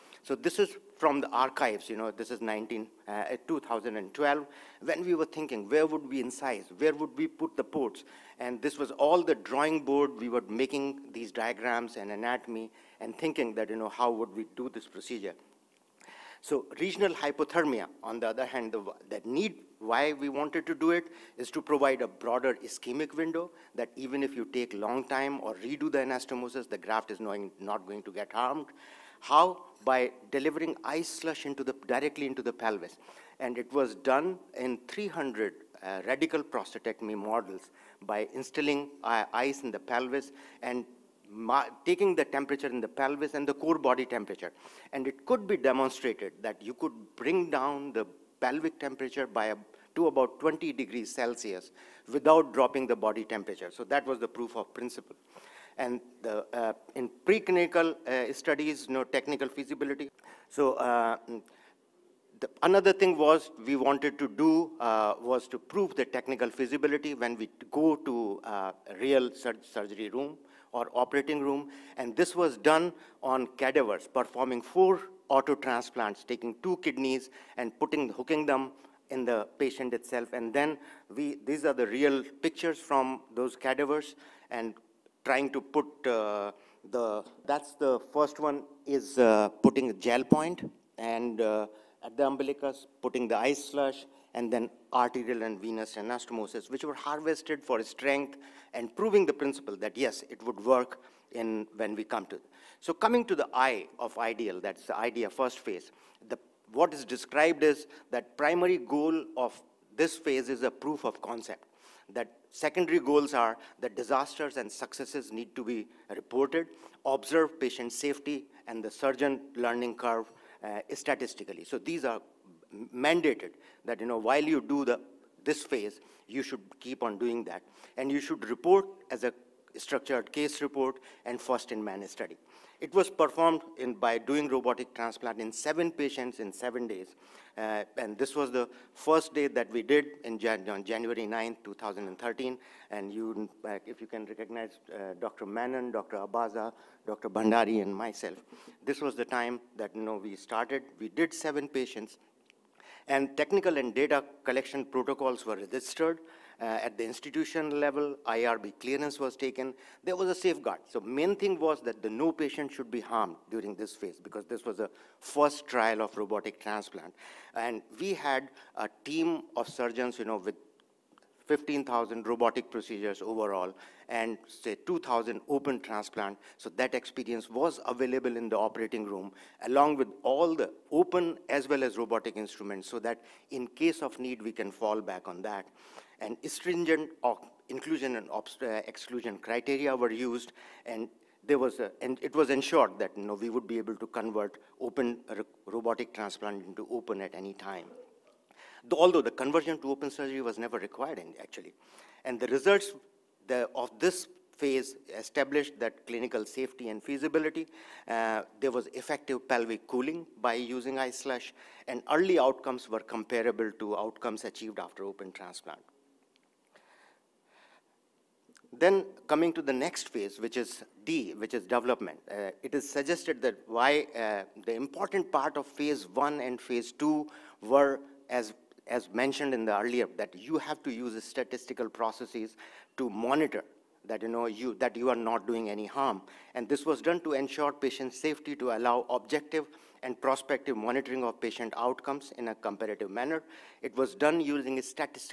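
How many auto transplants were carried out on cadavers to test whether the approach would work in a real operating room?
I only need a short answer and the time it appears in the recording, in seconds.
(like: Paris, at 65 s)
4, at 74 s.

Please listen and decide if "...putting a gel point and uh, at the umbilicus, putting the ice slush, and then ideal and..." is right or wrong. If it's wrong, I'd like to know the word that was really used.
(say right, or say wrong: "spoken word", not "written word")
wrong: "arterial", not "ideal".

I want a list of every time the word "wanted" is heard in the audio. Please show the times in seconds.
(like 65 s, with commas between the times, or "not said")
20 s, 63 s.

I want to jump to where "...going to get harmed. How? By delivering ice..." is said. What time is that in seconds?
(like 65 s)
27 s.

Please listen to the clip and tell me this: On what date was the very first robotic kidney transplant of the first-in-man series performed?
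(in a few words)
January 9, 2013.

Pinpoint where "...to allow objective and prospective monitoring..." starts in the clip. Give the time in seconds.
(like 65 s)
238 s.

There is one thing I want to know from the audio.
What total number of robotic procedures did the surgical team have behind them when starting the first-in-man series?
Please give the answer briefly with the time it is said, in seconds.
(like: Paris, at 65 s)
15,000, at 171 s.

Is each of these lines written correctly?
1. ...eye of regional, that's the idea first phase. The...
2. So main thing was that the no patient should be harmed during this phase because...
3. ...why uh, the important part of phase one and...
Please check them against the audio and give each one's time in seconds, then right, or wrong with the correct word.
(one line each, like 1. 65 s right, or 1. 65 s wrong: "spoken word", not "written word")
1. 103 s wrong: "ideal", not "regional"
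2. 160 s right
3. 223 s right.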